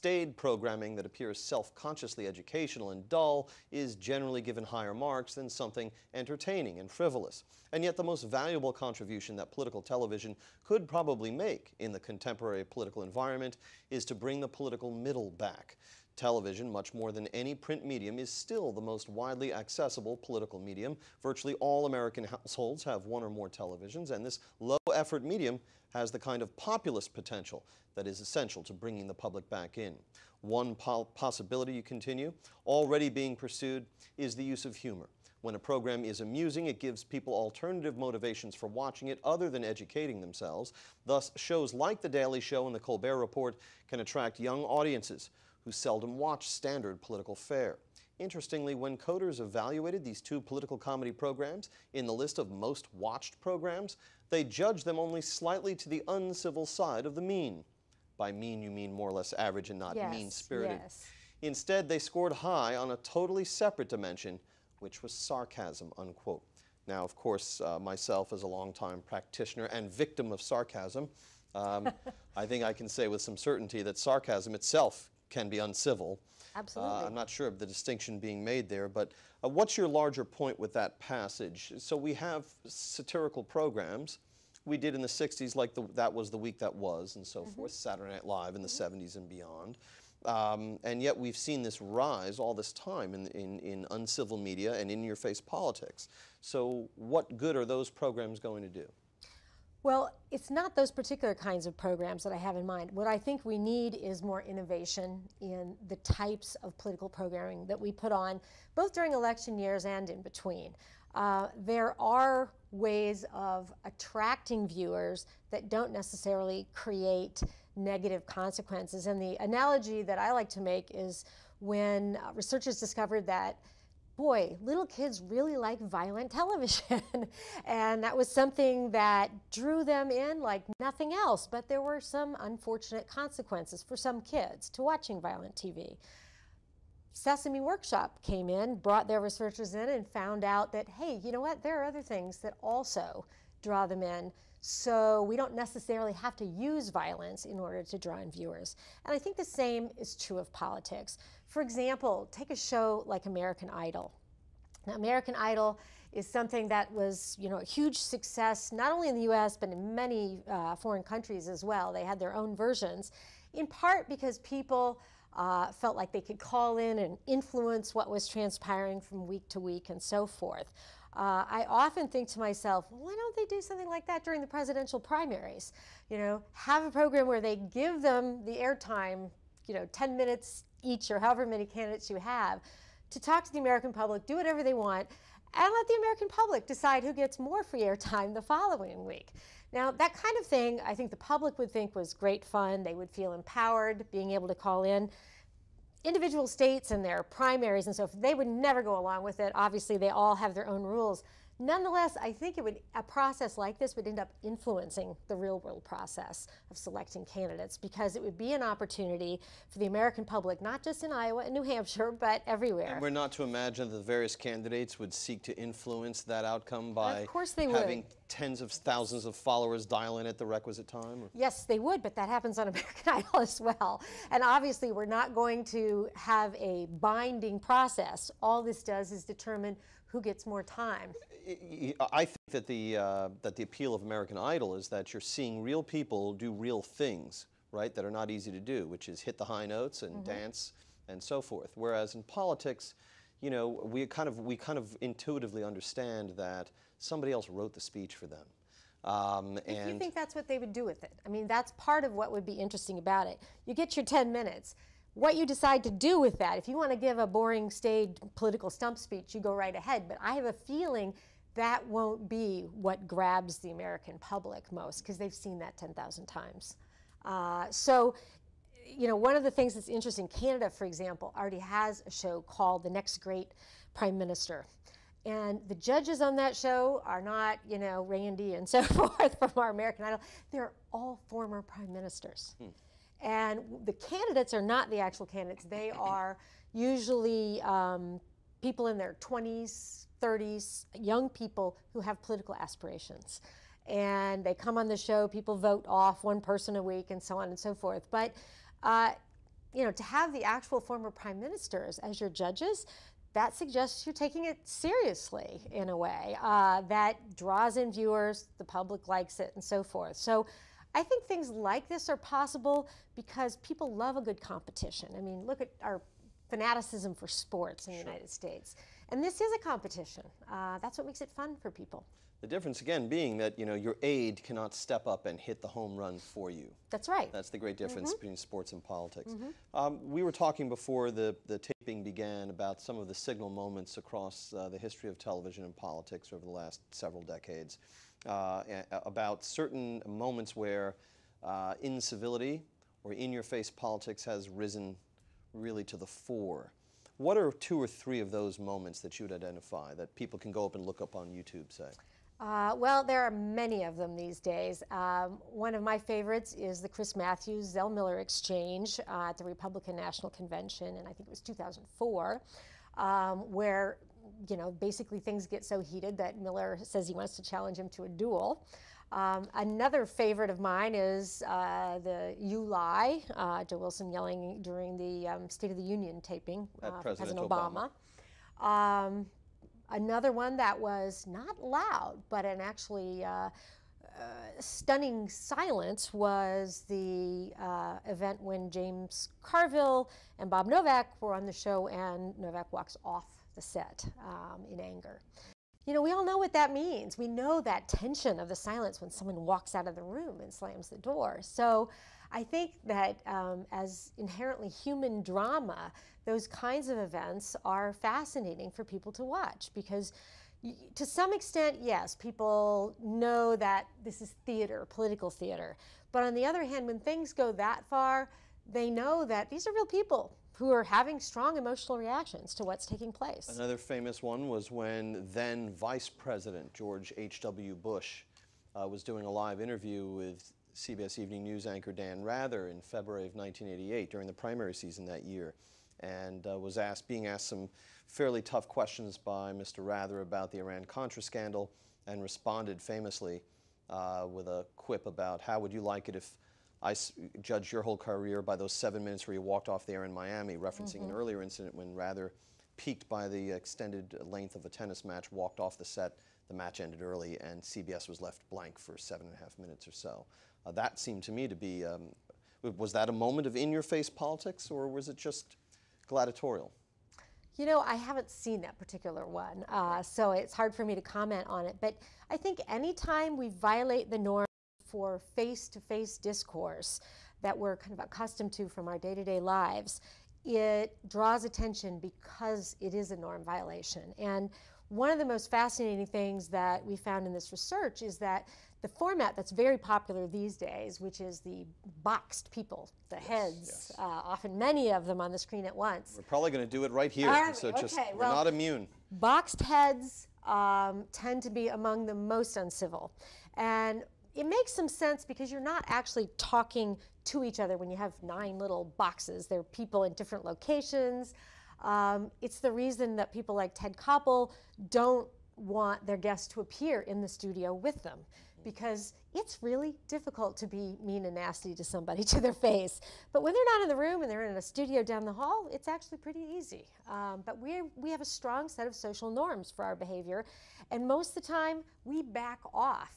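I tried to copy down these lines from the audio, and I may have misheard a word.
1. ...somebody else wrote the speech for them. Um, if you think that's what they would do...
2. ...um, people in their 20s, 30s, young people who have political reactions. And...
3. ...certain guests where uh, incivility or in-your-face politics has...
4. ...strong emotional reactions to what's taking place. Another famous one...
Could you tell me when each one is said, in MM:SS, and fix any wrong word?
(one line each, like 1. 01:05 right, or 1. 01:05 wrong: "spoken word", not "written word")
1. 04:06 right
2. 04:47 wrong: "aspirations", not "reactions"
3. 05:39 wrong: "moments", not "guests"
4. 07:01 right.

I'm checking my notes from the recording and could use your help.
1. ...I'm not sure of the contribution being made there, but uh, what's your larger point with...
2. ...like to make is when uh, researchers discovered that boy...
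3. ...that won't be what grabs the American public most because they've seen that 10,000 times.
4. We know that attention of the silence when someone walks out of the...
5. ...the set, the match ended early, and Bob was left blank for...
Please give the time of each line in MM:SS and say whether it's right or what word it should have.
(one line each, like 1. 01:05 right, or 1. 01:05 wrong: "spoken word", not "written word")
1. 01:17 wrong: "distinction", not "contribution"
2. 02:00 right
3. 04:21 right
4. 06:37 wrong: "tension", not "attention"
5. 07:35 wrong: "CBS", not "Bob".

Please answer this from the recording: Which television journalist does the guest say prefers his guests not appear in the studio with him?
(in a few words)
Ted Koppel.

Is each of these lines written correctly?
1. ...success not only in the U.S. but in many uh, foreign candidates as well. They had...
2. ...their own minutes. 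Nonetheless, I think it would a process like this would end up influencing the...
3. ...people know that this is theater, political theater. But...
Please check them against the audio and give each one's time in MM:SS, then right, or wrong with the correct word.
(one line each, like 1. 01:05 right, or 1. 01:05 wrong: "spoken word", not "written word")
1. 02:37 wrong: "countries", not "candidates"
2. 03:20 wrong: "rules", not "minutes"
3. 06:52 right.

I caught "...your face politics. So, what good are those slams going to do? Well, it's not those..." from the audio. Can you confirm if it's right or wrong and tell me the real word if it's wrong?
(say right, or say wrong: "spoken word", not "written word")
wrong: "programs", not "slams".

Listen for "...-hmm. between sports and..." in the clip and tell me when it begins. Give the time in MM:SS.
05:28.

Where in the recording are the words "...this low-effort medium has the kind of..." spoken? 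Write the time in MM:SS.
00:24.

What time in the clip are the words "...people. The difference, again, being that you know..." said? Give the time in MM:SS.
05:21.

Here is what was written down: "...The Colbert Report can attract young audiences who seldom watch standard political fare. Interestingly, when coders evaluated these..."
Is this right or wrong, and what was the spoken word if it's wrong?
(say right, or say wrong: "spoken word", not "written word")
right.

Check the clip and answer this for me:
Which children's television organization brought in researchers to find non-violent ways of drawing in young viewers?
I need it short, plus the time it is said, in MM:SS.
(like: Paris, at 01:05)
Sesame Workshop, at 02:17.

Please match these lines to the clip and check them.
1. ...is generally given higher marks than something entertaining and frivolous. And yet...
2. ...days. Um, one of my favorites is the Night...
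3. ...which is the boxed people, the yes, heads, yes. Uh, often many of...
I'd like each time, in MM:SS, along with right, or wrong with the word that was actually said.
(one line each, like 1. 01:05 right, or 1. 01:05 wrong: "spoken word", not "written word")
1. 00:03 right
2. 05:54 wrong: "Chris", not "Night"
3. 08:10 right.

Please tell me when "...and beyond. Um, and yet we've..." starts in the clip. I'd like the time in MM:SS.
01:29.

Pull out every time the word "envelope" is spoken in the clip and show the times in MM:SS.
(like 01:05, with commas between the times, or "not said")
not said.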